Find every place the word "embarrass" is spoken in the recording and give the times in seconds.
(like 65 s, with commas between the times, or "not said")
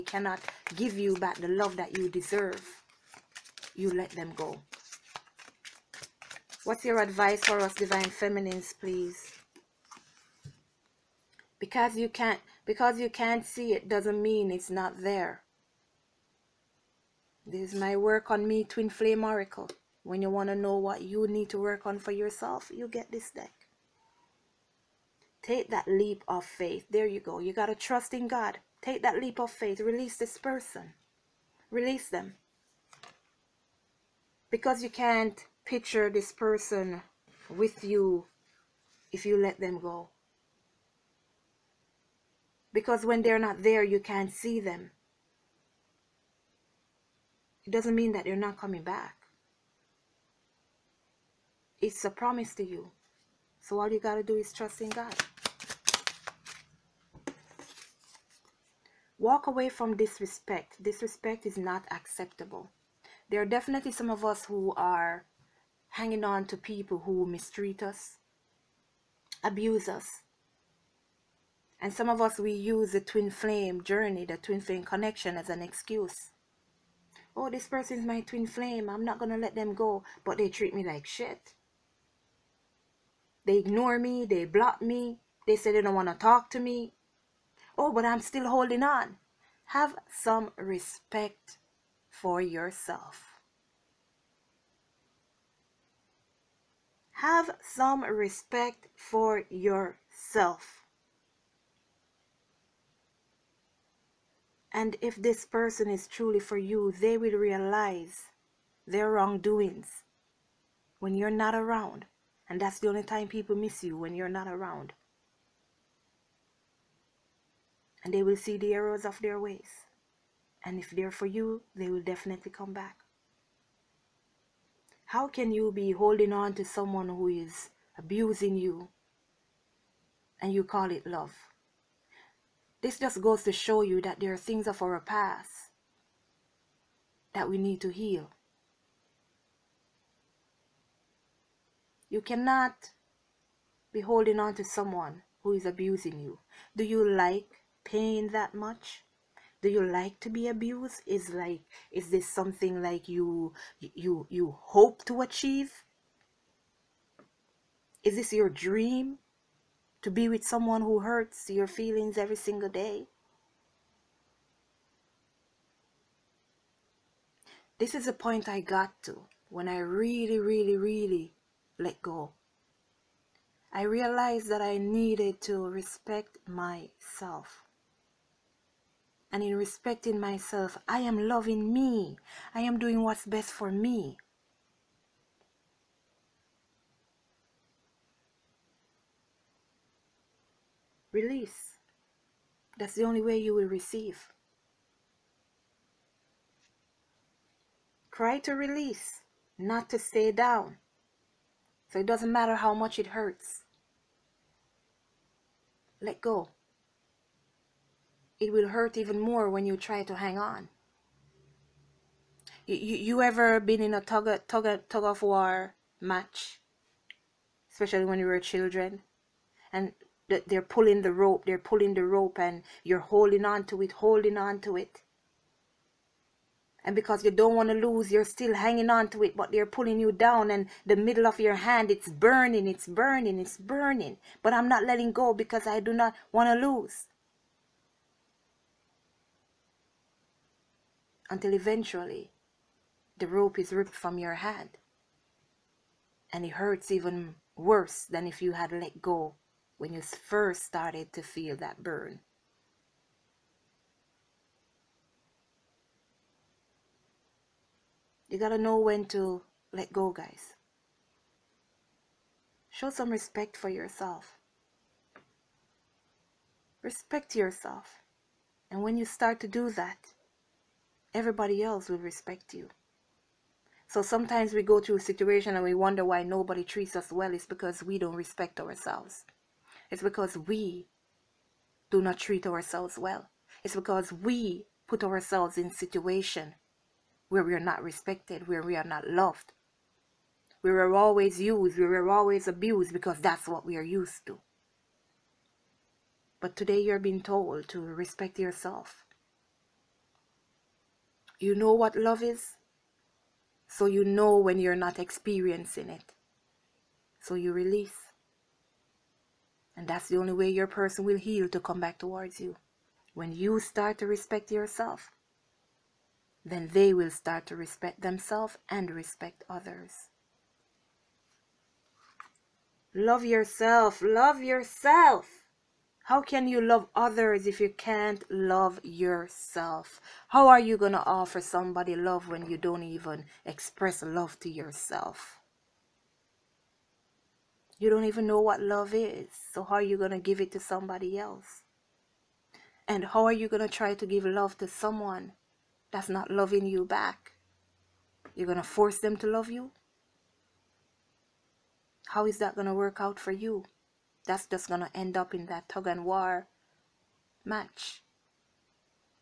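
not said.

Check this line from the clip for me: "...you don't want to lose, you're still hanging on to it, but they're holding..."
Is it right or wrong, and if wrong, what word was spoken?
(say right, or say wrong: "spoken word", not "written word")
wrong: "pulling", not "holding".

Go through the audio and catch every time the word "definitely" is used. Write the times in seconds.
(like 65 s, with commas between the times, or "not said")
63 s, 122 s.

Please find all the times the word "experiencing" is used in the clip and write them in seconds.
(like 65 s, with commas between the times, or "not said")
304 s.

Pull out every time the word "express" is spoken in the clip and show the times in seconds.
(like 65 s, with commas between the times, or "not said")
333 s.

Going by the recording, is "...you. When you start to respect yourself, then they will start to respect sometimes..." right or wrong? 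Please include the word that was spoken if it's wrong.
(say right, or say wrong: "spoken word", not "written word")
wrong: "themselves", not "sometimes".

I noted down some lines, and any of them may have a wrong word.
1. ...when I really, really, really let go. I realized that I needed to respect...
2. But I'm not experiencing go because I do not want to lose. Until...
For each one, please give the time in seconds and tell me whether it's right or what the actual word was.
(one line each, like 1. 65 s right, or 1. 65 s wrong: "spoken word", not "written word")
1. 169 s right
2. 234 s wrong: "letting", not "experiencing".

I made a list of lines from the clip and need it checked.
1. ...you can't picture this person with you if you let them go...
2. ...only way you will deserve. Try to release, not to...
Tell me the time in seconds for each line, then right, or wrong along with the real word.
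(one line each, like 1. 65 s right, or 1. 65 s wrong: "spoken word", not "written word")
1. 34 s right
2. 193 s wrong: "receive", not "deserve".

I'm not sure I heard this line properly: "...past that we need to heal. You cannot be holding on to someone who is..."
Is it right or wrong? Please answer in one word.
right.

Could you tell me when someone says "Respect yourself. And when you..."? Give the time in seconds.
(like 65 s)
266 s.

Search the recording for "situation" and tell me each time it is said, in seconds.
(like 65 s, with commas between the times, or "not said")
274 s, 285 s.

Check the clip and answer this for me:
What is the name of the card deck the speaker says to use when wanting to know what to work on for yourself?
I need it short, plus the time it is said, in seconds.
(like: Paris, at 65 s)
Twin Flame Oracle, at 18 s.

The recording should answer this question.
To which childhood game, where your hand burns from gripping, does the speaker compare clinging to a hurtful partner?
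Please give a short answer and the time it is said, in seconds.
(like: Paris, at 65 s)
Tug of war, at 214 s.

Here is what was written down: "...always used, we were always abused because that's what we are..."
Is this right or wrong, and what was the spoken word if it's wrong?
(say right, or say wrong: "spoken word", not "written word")
right.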